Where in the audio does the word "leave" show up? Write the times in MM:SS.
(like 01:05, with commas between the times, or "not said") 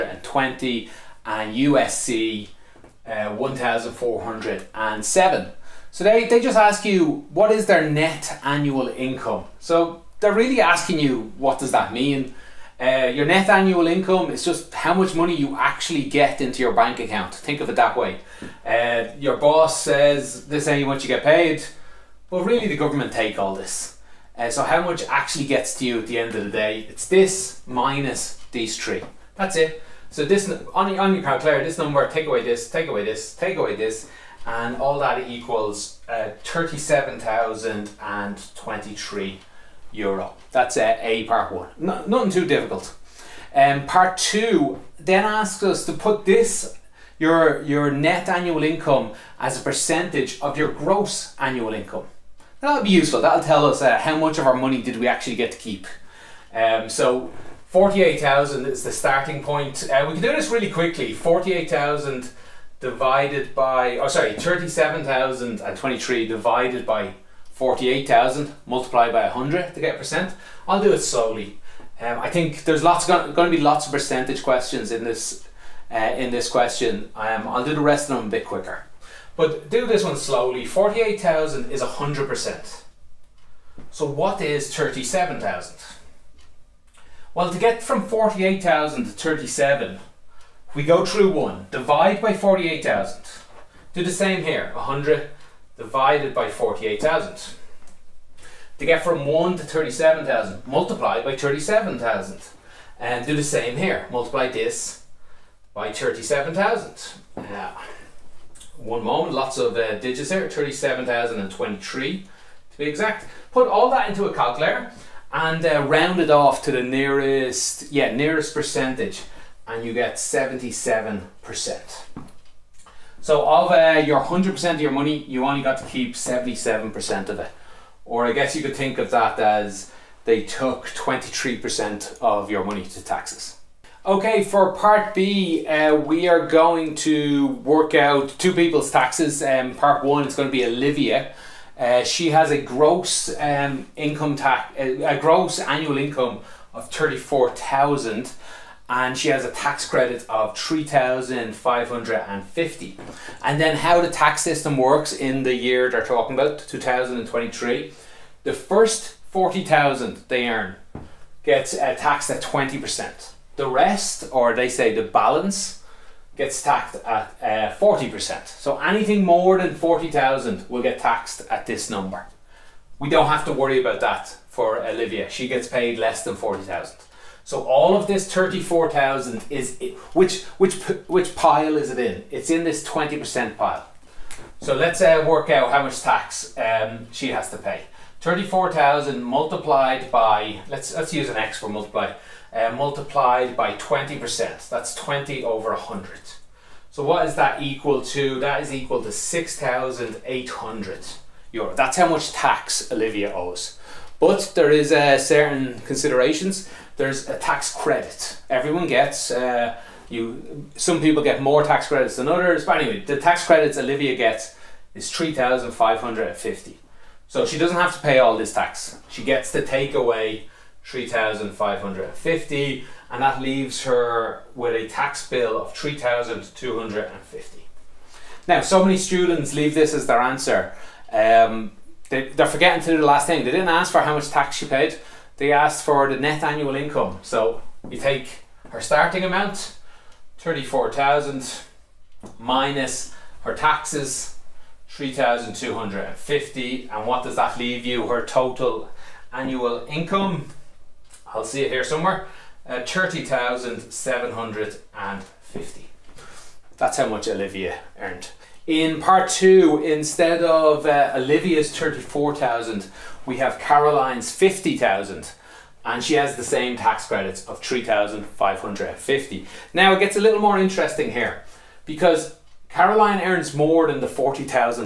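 03:43, 03:49, 04:07.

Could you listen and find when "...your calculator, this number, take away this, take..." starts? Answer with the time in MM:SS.
00:31.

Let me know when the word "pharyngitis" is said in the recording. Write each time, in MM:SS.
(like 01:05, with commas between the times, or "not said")
not said.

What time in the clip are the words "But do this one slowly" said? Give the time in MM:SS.
01:19.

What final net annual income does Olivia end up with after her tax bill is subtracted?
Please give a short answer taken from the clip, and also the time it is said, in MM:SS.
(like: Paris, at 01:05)
30,750, at 04:12.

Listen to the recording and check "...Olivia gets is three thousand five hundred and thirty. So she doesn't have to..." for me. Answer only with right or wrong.
wrong.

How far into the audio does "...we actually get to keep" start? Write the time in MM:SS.
00:54.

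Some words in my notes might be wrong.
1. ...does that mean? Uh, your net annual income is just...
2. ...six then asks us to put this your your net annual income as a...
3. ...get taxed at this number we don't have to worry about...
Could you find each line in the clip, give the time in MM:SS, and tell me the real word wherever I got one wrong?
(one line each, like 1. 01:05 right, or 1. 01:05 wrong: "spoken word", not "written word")
1. 00:11 right
2. 00:44 wrong: "two", not "six"
3. 02:50 right.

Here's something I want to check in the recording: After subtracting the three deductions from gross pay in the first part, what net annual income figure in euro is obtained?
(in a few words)
€37,023.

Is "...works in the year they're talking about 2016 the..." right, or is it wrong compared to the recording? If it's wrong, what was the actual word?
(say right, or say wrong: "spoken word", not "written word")
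wrong: "2023", not "2016".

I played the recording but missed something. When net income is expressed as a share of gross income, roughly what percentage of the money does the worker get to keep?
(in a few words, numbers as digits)
77%.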